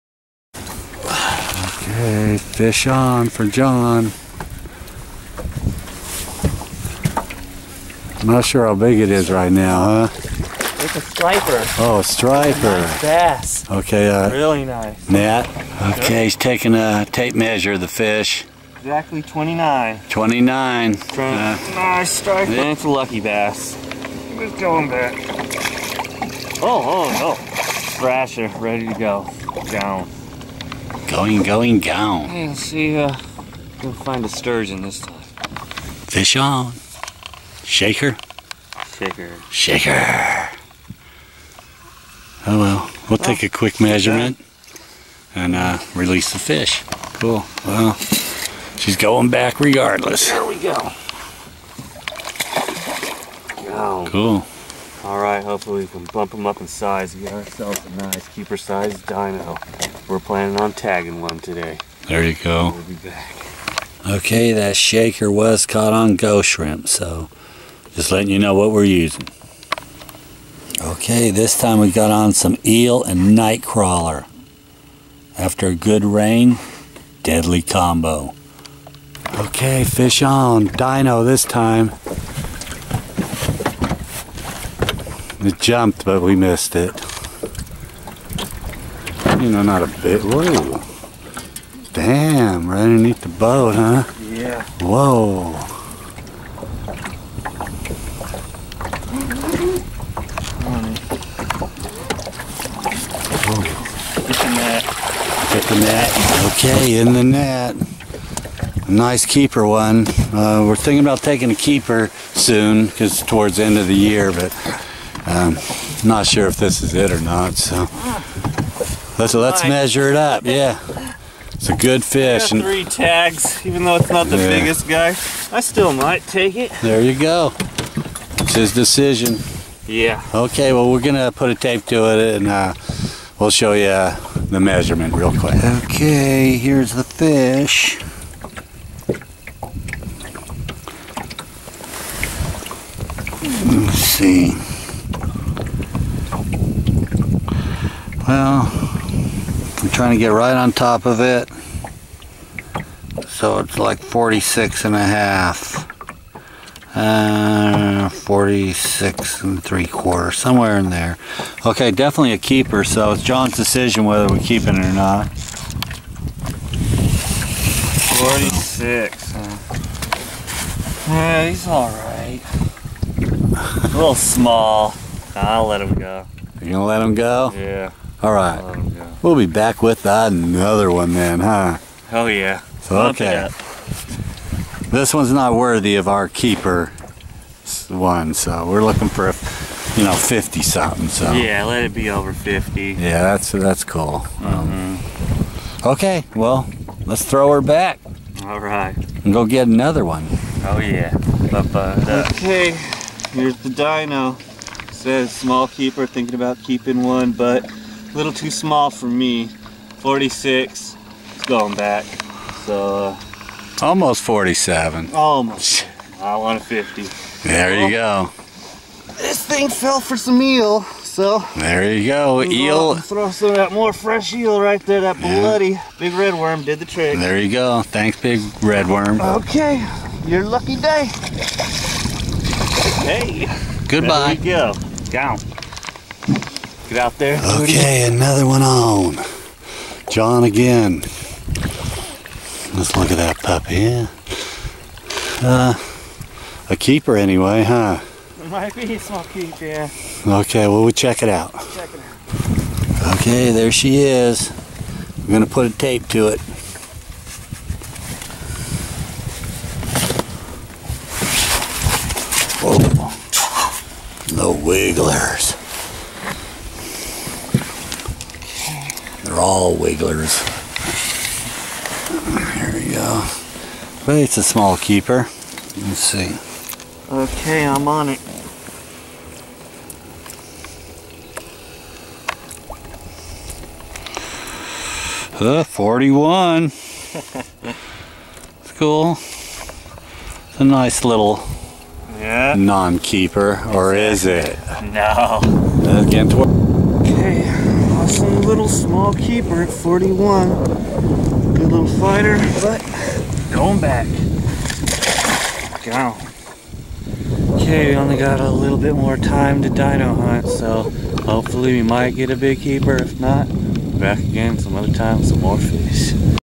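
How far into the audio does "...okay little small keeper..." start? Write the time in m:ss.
4:57.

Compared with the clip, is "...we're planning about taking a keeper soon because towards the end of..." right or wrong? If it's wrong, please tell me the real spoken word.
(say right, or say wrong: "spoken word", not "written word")
wrong: "thinking", not "planning".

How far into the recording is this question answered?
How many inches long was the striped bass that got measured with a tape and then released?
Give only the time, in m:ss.
0:18.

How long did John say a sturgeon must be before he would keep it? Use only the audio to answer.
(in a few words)
over 50.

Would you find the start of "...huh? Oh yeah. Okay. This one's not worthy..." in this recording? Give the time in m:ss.
3:01.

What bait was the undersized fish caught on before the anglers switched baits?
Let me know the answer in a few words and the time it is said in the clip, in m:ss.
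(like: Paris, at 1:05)
ghost shrimp, at 1:06.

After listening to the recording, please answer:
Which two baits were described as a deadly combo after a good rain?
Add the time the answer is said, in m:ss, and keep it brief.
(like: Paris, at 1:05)
eel and night crawler, at 1:12.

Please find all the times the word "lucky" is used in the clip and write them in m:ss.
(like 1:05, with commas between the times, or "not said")
0:22, 3:50.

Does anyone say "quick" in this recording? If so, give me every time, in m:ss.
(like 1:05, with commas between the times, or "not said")
0:43, 2:15.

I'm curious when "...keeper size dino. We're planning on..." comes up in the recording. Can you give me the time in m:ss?
0:58.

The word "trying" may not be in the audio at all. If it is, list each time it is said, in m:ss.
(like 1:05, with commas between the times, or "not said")
2:30.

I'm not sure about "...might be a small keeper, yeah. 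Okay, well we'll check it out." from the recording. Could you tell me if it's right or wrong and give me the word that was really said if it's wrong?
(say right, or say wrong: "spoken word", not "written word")
right.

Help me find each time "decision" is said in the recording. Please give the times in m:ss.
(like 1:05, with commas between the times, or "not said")
2:08, 2:43.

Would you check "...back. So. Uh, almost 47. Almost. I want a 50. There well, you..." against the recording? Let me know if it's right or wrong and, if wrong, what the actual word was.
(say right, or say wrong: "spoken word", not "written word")
right.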